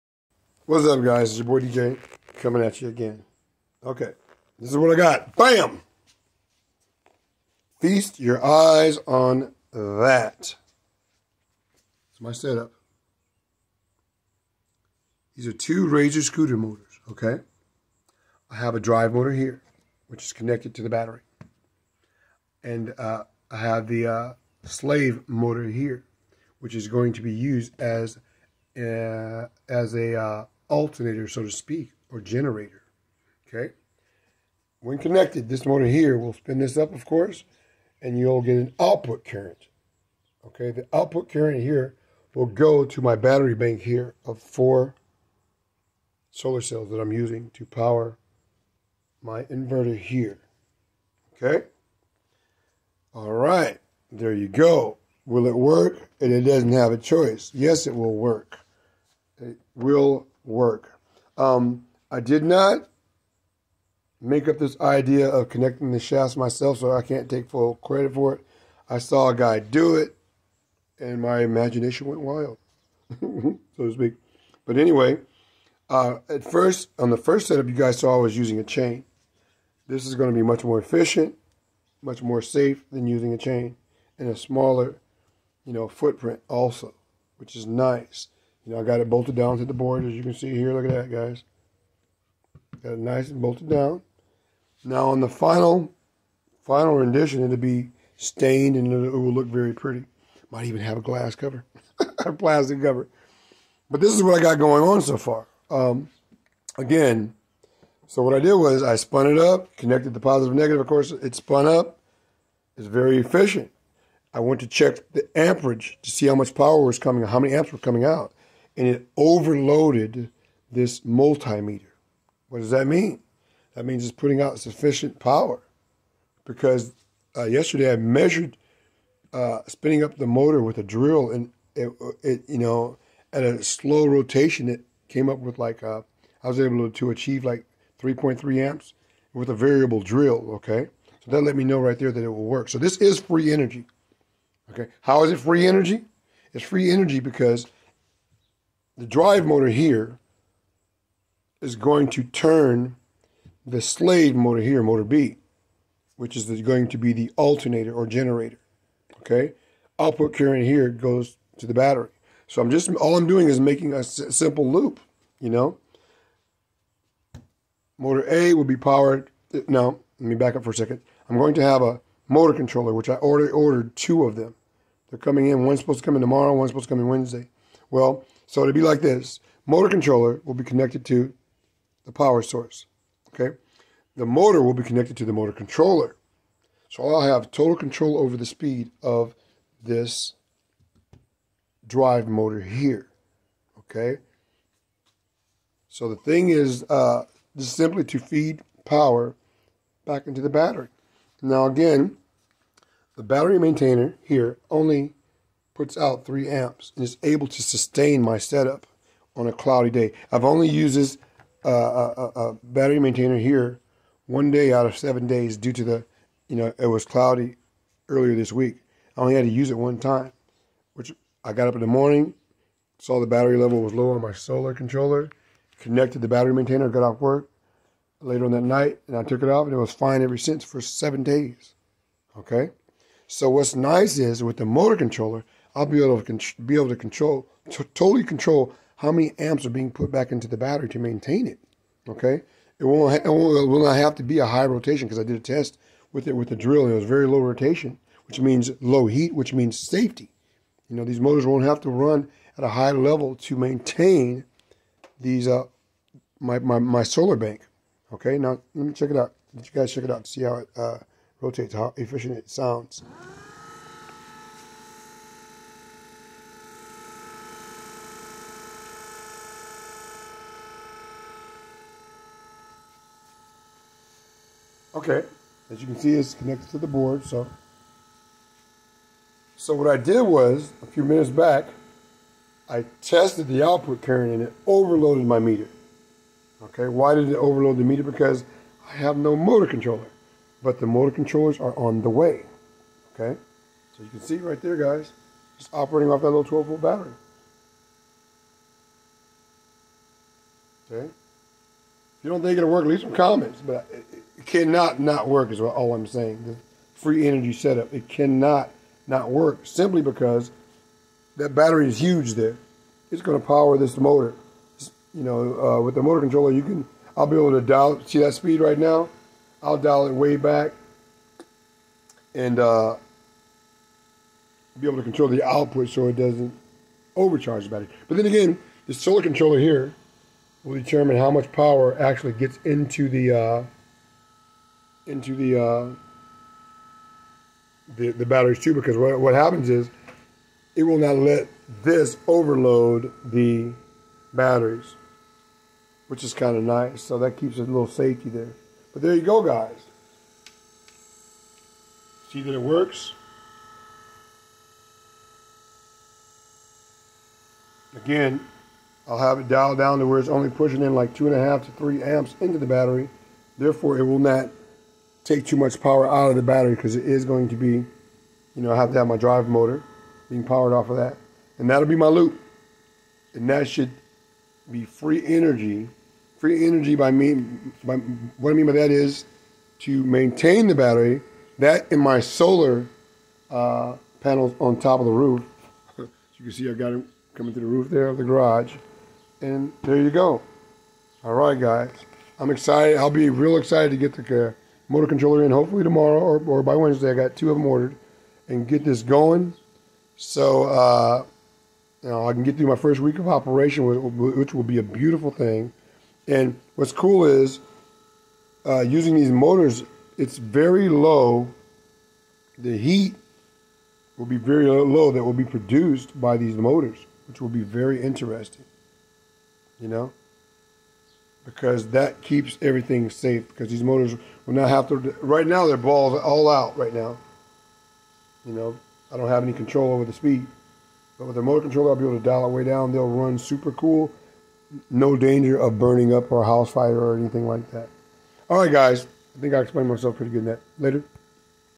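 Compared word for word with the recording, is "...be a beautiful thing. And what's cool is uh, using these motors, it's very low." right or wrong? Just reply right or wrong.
right.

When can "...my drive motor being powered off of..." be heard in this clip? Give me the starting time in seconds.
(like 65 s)
369 s.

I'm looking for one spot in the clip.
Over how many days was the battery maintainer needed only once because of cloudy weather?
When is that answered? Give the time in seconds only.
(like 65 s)
214 s.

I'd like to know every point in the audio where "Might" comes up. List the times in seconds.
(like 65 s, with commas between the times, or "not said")
100 s.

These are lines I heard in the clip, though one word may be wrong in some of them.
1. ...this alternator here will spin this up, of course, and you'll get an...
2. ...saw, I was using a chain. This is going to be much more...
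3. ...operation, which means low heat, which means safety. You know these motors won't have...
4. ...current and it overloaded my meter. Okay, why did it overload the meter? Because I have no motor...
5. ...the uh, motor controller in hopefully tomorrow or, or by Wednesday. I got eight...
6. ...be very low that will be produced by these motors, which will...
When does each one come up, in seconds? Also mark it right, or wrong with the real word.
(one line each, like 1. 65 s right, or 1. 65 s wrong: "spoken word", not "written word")
1. 35 s wrong: "motor", not "alternator"
2. 77 s right
3. 247 s wrong: "rotation", not "operation"
4. 284 s right
5. 394 s wrong: "two", not "eight"
6. 414 s right.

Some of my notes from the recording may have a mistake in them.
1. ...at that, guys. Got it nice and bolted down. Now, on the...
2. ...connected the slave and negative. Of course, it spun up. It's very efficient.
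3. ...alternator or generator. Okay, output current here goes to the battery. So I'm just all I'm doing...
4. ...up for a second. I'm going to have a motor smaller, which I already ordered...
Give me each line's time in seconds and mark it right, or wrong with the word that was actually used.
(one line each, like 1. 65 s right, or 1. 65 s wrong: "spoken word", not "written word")
1. 90 s right
2. 109 s wrong: "positive", not "slave"
3. 157 s right
4. 170 s wrong: "controller", not "smaller".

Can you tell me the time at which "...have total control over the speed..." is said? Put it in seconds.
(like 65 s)
187 s.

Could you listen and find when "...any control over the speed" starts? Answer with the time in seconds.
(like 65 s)
429 s.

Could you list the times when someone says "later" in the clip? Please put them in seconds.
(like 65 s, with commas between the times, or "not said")
228 s, 440 s.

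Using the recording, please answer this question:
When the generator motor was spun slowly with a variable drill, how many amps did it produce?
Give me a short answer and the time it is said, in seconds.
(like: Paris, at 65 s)
3.3 amps, at 138 s.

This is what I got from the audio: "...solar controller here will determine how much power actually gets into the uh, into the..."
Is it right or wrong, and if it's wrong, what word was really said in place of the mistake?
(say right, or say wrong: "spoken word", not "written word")
right.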